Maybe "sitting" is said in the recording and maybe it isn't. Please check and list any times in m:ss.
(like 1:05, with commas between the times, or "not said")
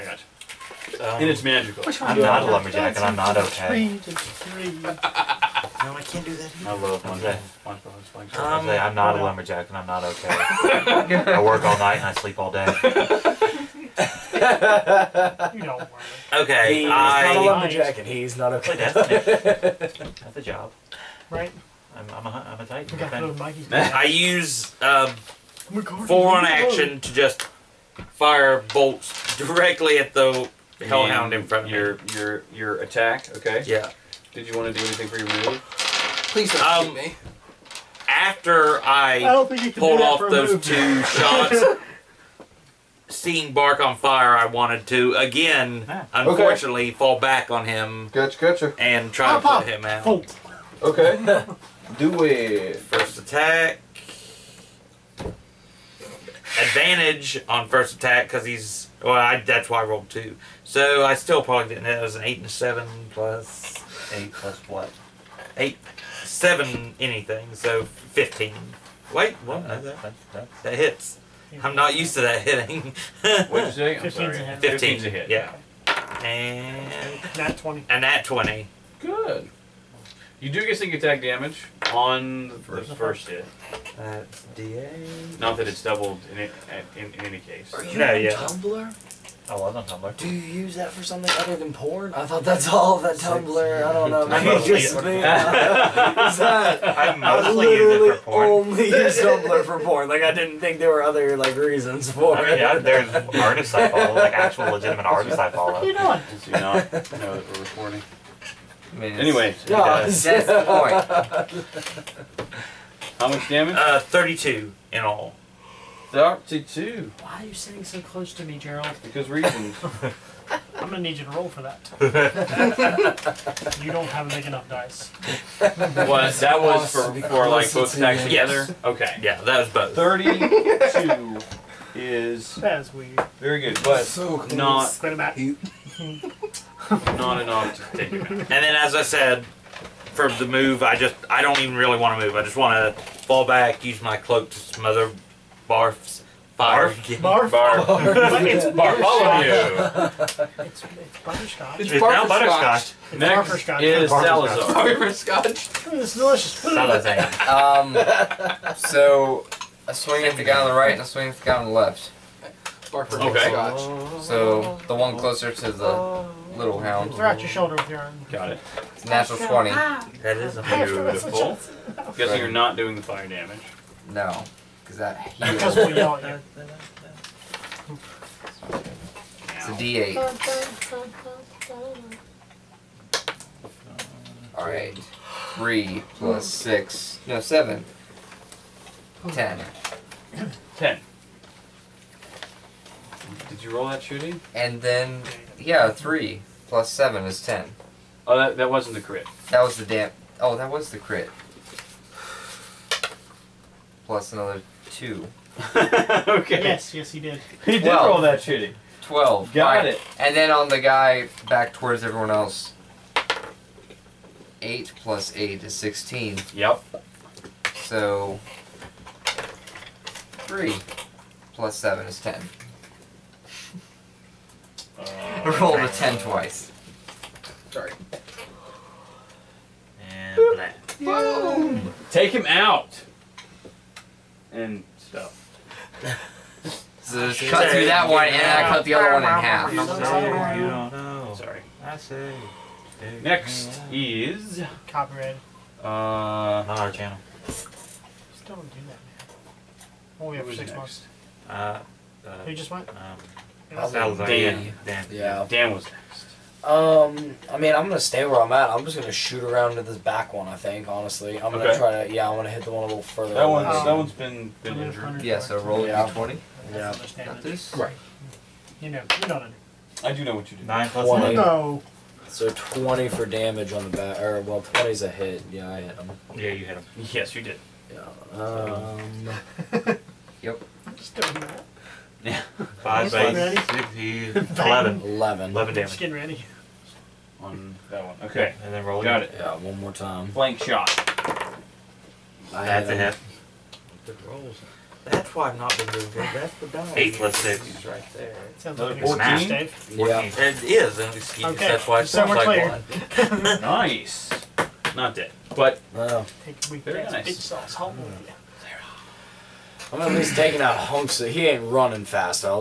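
1:57.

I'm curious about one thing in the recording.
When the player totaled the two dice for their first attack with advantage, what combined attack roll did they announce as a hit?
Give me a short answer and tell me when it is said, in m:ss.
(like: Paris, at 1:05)
15, at 1:07.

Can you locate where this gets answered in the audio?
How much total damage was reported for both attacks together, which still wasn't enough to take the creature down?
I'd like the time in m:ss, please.
1:53.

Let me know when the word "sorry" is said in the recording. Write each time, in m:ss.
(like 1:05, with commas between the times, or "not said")
1:14, 3:47, 4:01.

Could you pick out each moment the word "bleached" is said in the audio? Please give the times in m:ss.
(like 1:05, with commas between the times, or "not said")
not said.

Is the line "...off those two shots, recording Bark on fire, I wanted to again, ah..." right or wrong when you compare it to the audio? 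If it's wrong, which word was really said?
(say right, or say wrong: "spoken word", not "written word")
wrong: "seeing", not "recording".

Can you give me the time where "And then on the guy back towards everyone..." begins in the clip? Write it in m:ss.
3:30.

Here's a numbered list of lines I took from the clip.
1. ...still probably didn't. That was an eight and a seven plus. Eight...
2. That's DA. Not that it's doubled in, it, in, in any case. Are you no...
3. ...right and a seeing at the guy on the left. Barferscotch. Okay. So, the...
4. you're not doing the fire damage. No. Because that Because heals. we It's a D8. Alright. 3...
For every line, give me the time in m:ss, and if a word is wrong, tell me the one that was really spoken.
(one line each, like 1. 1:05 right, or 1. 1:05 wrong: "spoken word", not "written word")
1. 1:01 right
2. 1:23 right
3. 2:40 wrong: "swing", not "seeing"
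4. 2:52 right.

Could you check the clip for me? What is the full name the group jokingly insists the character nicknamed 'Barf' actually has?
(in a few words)
Bartholomew.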